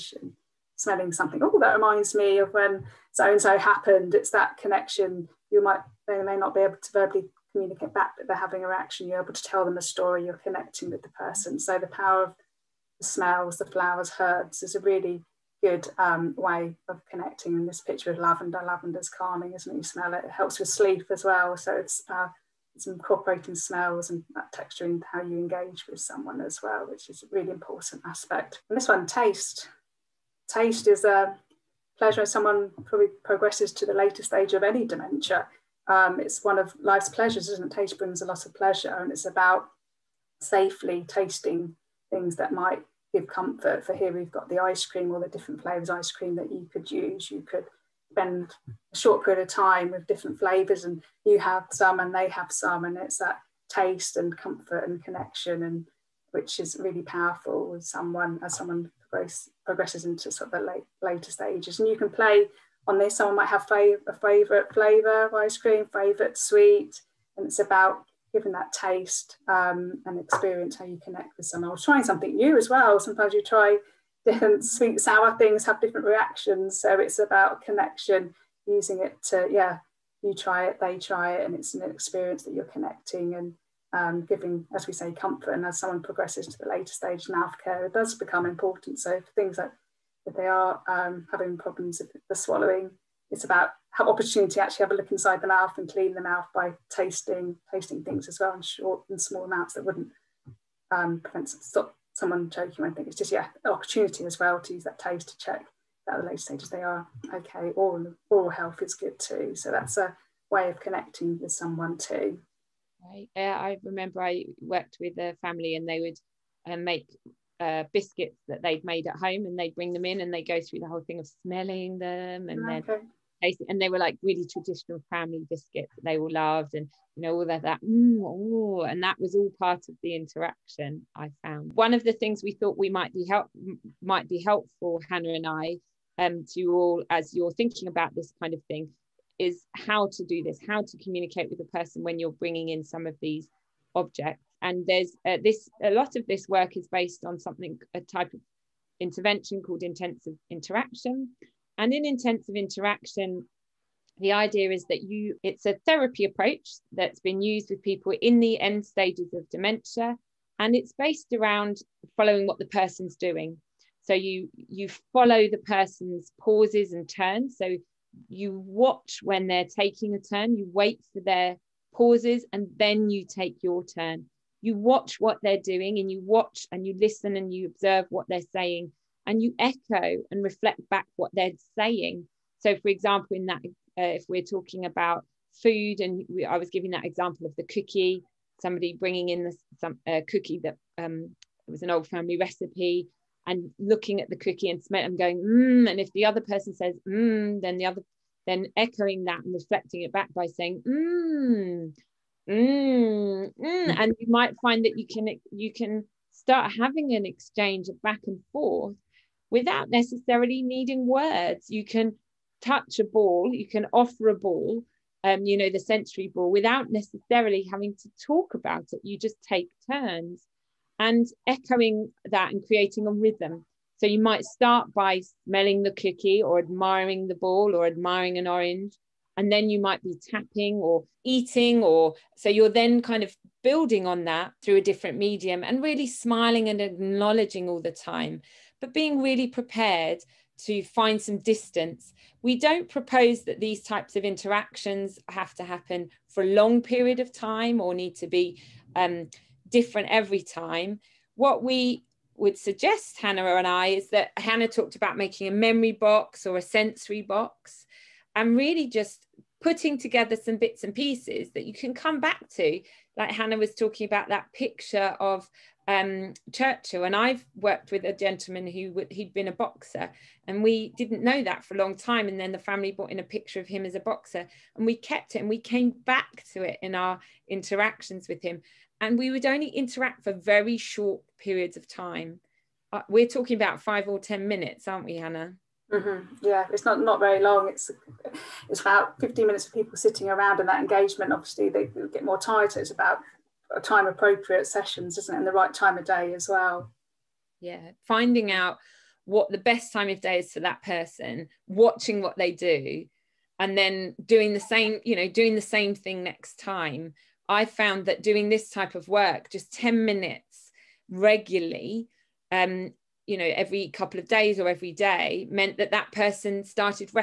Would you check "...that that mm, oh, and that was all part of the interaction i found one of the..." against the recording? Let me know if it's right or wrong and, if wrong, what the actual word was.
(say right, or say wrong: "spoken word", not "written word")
right.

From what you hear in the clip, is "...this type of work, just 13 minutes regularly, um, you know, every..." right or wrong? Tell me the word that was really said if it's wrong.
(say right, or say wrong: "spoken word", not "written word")
wrong: "10", not "13".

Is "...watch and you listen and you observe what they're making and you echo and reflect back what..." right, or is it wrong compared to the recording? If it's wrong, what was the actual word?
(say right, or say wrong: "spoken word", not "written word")
wrong: "saying", not "making".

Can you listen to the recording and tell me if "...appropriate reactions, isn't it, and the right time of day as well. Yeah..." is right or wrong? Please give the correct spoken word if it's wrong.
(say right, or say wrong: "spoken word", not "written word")
wrong: "sessions", not "reactions".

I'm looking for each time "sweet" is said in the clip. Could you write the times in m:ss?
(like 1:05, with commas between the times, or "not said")
1:06, 1:14.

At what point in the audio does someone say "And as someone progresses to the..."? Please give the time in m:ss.
1:25.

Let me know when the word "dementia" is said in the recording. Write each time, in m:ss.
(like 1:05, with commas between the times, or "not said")
0:34, 2:39.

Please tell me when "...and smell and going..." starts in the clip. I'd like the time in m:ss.
3:14.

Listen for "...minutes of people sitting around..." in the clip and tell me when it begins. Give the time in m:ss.
4:49.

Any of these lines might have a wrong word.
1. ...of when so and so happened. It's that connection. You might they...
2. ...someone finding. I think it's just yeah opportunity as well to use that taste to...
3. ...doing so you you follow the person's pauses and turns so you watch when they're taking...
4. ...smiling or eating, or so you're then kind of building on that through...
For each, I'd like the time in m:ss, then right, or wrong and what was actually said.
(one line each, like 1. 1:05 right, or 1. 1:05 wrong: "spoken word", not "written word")
1. 0:02 right
2. 1:42 wrong: "choking", not "finding"
3. 2:43 right
4. 3:50 wrong: "tapping", not "smiling".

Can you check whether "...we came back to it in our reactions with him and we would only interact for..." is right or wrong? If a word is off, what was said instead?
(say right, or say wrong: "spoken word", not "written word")
wrong: "interactions", not "reactions".